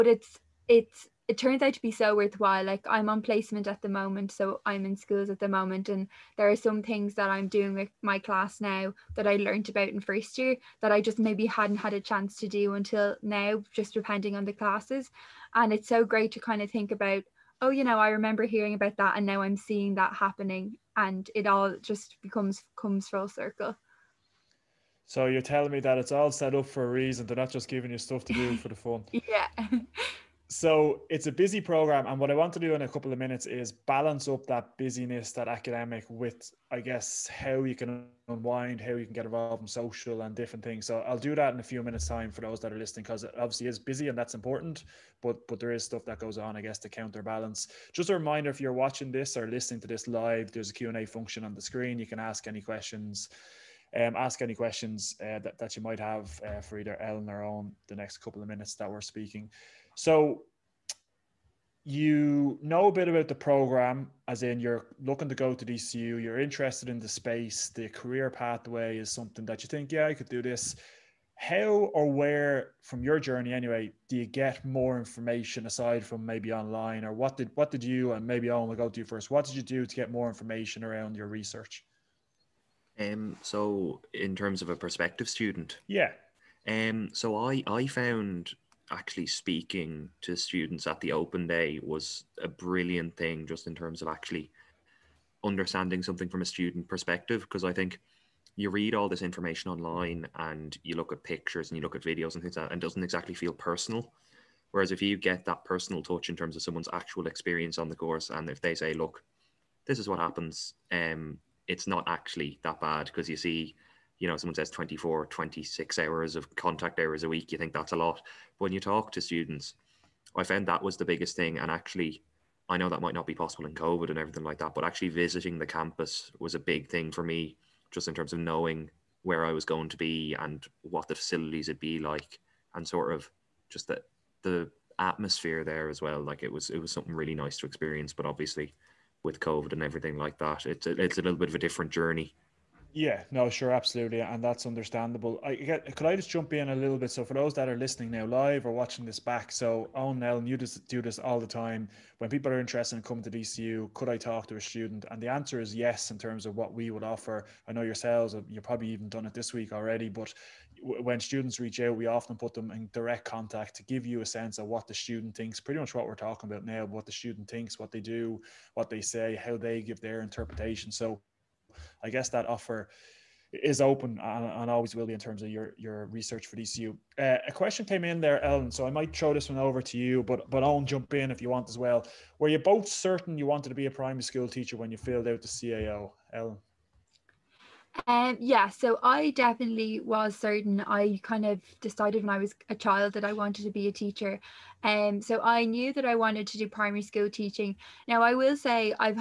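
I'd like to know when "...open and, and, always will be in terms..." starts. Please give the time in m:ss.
2:53.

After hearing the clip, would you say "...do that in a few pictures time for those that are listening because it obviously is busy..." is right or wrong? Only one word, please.
wrong.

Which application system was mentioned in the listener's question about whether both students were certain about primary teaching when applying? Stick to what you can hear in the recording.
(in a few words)
CAO.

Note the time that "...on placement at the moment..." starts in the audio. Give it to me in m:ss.
0:03.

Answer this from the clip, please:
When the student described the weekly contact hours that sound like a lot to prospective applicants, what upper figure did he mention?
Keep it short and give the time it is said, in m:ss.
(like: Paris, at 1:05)
26, at 1:55.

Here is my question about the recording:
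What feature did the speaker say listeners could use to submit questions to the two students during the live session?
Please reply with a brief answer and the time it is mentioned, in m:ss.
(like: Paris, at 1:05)
Q&A function, at 0:50.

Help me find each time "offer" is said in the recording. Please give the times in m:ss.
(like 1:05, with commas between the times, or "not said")
2:37, 2:52.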